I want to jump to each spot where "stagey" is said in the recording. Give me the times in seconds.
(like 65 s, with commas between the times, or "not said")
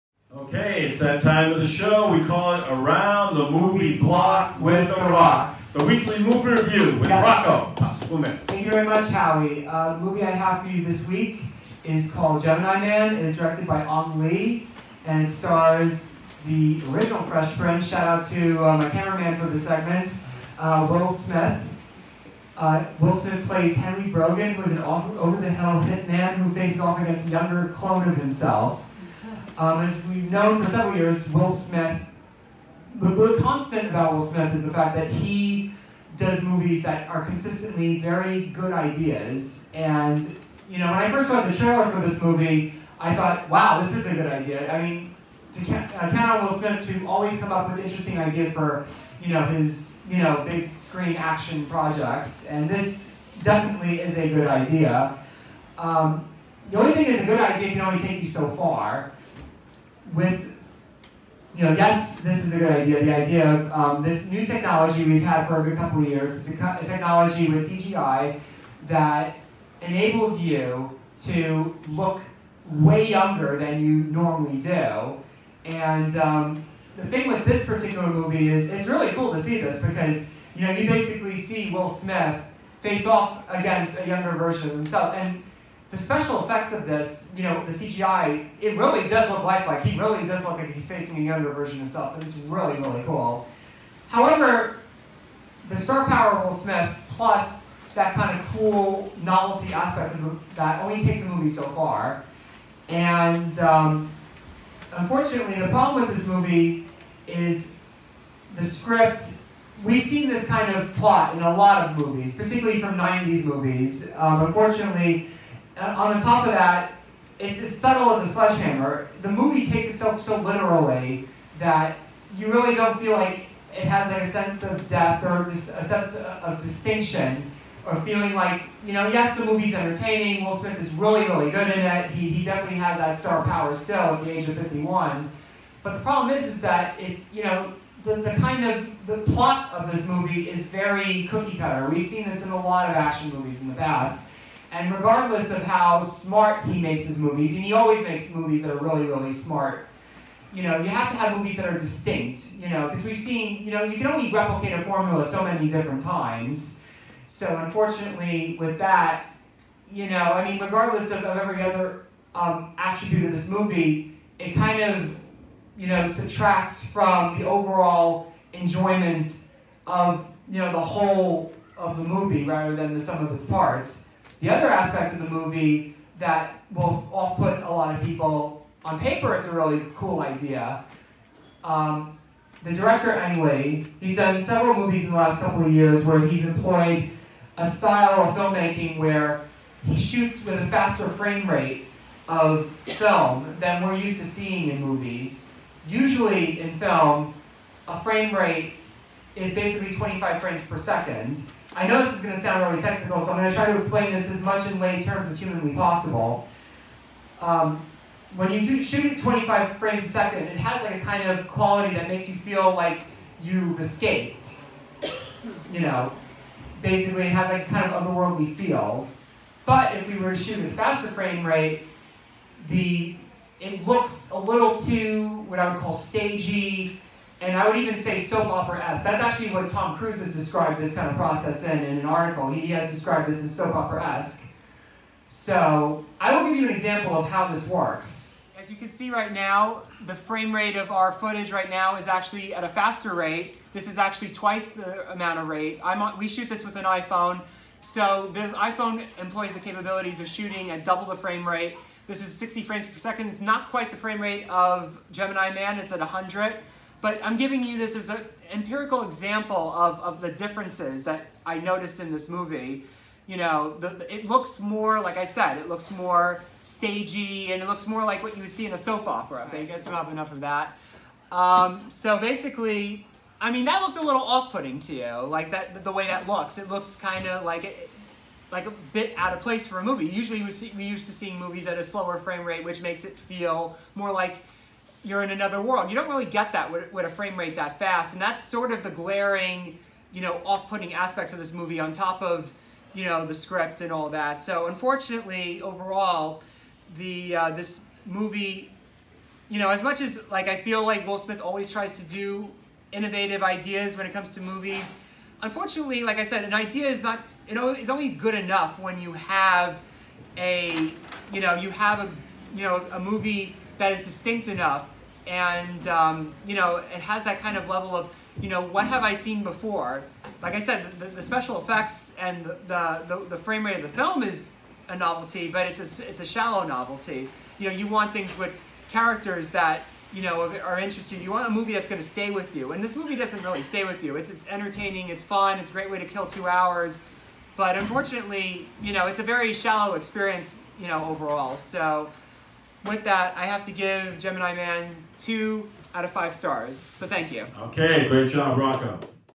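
225 s, 266 s.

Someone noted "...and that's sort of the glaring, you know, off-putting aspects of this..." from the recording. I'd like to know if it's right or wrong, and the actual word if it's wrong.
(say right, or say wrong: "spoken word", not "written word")
right.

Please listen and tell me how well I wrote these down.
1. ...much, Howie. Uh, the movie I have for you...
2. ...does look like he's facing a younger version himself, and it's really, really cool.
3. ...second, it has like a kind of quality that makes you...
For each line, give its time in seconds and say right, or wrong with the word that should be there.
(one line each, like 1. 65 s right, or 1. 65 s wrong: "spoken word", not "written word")
1. 8 s right
2. 90 s right
3. 210 s right.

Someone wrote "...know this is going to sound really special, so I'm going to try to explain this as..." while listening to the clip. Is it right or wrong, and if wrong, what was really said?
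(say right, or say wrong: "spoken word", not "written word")
wrong: "technical", not "special".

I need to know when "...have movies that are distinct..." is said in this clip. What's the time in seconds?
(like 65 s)
151 s.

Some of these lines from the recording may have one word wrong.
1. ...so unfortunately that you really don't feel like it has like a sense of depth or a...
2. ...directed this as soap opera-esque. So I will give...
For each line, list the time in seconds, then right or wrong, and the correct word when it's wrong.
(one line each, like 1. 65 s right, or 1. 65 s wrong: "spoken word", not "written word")
1. 120 s wrong: "literally", not "unfortunately"
2. 232 s wrong: "described", not "directed".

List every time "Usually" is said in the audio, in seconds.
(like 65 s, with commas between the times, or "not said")
195 s, 280 s.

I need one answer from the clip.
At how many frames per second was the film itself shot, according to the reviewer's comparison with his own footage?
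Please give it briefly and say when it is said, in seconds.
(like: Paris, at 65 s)
100, at 255 s.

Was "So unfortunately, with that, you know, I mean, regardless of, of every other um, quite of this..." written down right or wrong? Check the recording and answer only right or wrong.
wrong.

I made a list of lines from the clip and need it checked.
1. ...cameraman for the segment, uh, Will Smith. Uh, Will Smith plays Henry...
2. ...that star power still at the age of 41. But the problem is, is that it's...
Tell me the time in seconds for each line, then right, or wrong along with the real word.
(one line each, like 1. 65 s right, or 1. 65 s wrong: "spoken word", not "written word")
1. 18 s right
2. 132 s wrong: "51", not "41".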